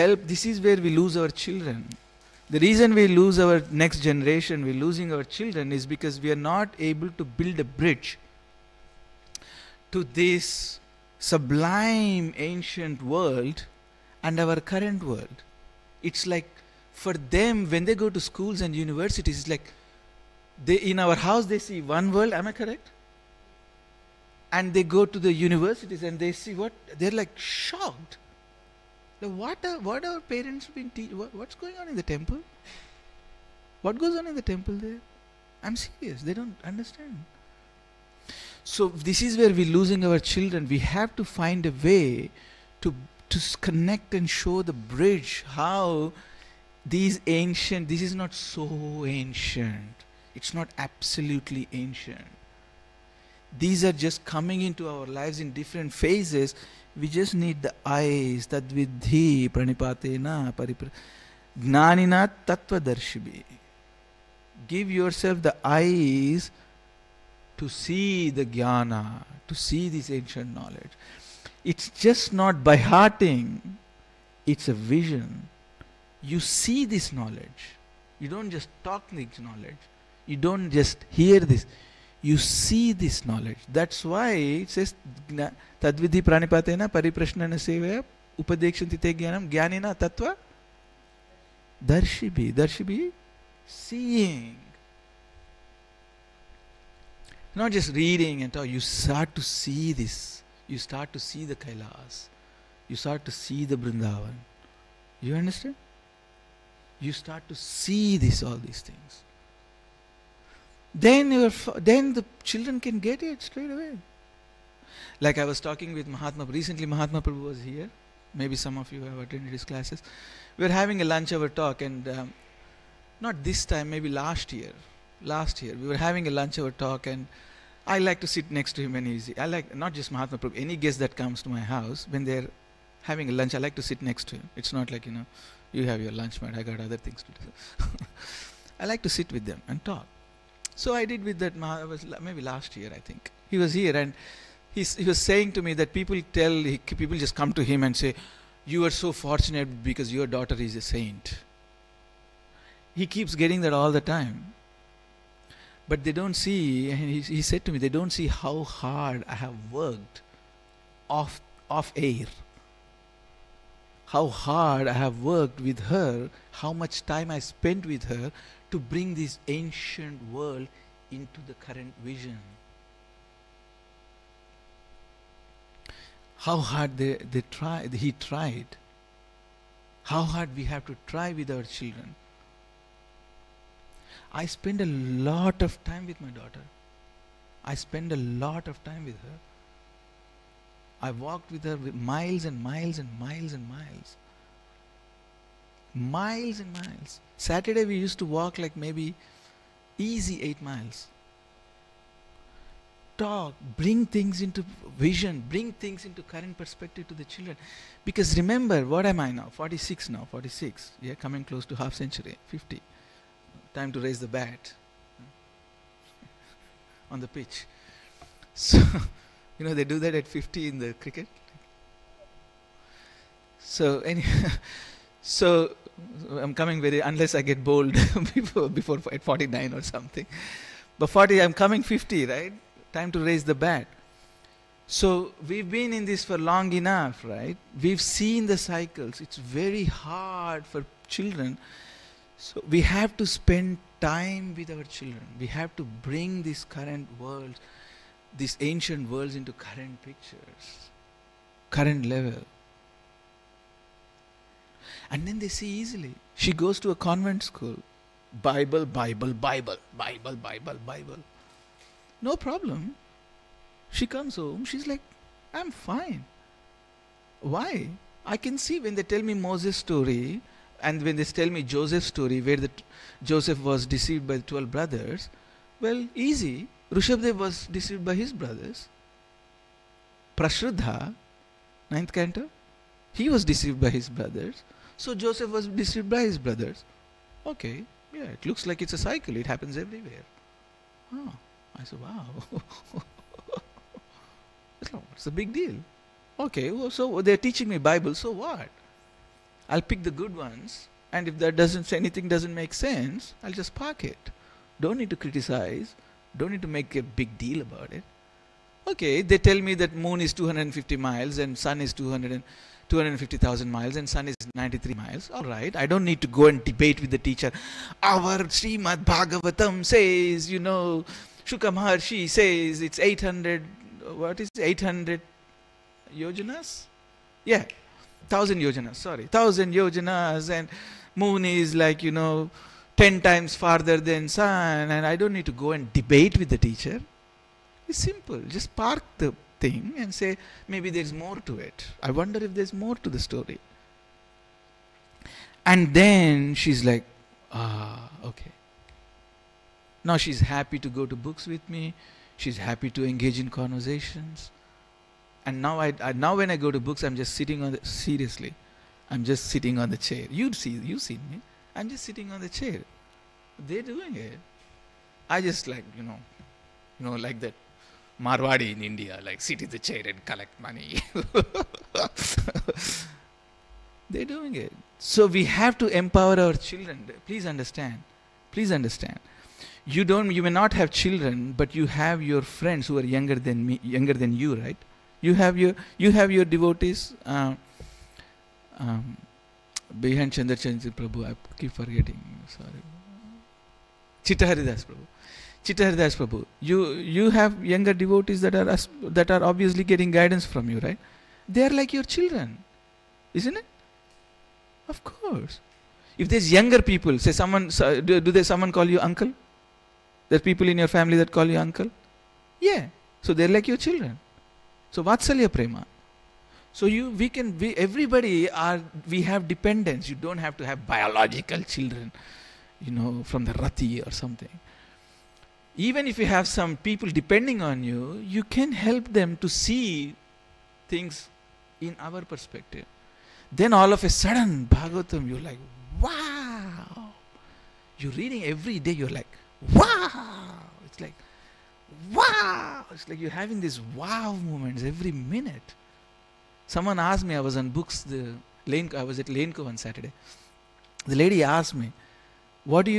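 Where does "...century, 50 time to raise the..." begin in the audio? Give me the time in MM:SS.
03:31.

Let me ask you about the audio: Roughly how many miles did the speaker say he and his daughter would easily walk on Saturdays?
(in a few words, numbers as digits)
8 miles.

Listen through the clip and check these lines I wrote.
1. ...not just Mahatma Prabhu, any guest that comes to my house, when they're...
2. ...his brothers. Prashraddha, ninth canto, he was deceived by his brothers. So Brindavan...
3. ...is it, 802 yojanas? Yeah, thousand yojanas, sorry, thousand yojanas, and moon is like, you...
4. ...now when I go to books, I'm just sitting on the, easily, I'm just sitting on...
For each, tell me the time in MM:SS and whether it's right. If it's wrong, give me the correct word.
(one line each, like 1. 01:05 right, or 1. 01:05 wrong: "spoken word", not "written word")
1. 02:09 right
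2. 04:38 wrong: "Joseph", not "Brindavan"
3. 05:24 wrong: "800", not "802"
4. 05:56 wrong: "seriously", not "easily".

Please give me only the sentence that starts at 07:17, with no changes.
You're reading every day, you're like, wow.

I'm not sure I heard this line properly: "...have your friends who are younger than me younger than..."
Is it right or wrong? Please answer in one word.
right.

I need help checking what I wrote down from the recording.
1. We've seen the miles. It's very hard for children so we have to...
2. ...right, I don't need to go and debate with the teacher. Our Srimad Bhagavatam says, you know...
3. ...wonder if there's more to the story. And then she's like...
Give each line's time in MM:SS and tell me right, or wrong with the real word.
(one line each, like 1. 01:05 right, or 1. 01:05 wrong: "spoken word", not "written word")
1. 03:57 wrong: "cycles", not "miles"
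2. 05:15 right
3. 05:42 right.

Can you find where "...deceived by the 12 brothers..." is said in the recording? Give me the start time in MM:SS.
04:33.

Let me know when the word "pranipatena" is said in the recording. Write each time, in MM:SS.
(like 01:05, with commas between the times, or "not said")
00:59, 01:26.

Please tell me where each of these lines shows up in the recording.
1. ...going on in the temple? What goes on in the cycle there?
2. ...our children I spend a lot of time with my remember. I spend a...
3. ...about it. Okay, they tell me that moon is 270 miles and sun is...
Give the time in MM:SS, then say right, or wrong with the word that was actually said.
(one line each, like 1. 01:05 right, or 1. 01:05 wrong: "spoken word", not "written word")
1. 00:31 wrong: "temple", not "cycle"
2. 03:01 wrong: "daughter", not "remember"
3. 05:07 wrong: "250", not "270".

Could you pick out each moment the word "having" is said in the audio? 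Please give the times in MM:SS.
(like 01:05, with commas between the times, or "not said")
02:00, 02:05, 02:13, 07:23.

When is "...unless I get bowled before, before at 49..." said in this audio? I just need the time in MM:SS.
03:47.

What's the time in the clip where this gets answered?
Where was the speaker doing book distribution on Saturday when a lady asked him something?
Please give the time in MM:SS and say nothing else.
07:29.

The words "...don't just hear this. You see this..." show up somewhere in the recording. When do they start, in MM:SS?
01:20.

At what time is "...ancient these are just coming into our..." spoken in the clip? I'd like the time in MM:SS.
00:51.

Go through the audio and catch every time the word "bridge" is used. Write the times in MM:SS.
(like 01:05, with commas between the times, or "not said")
00:07, 00:44.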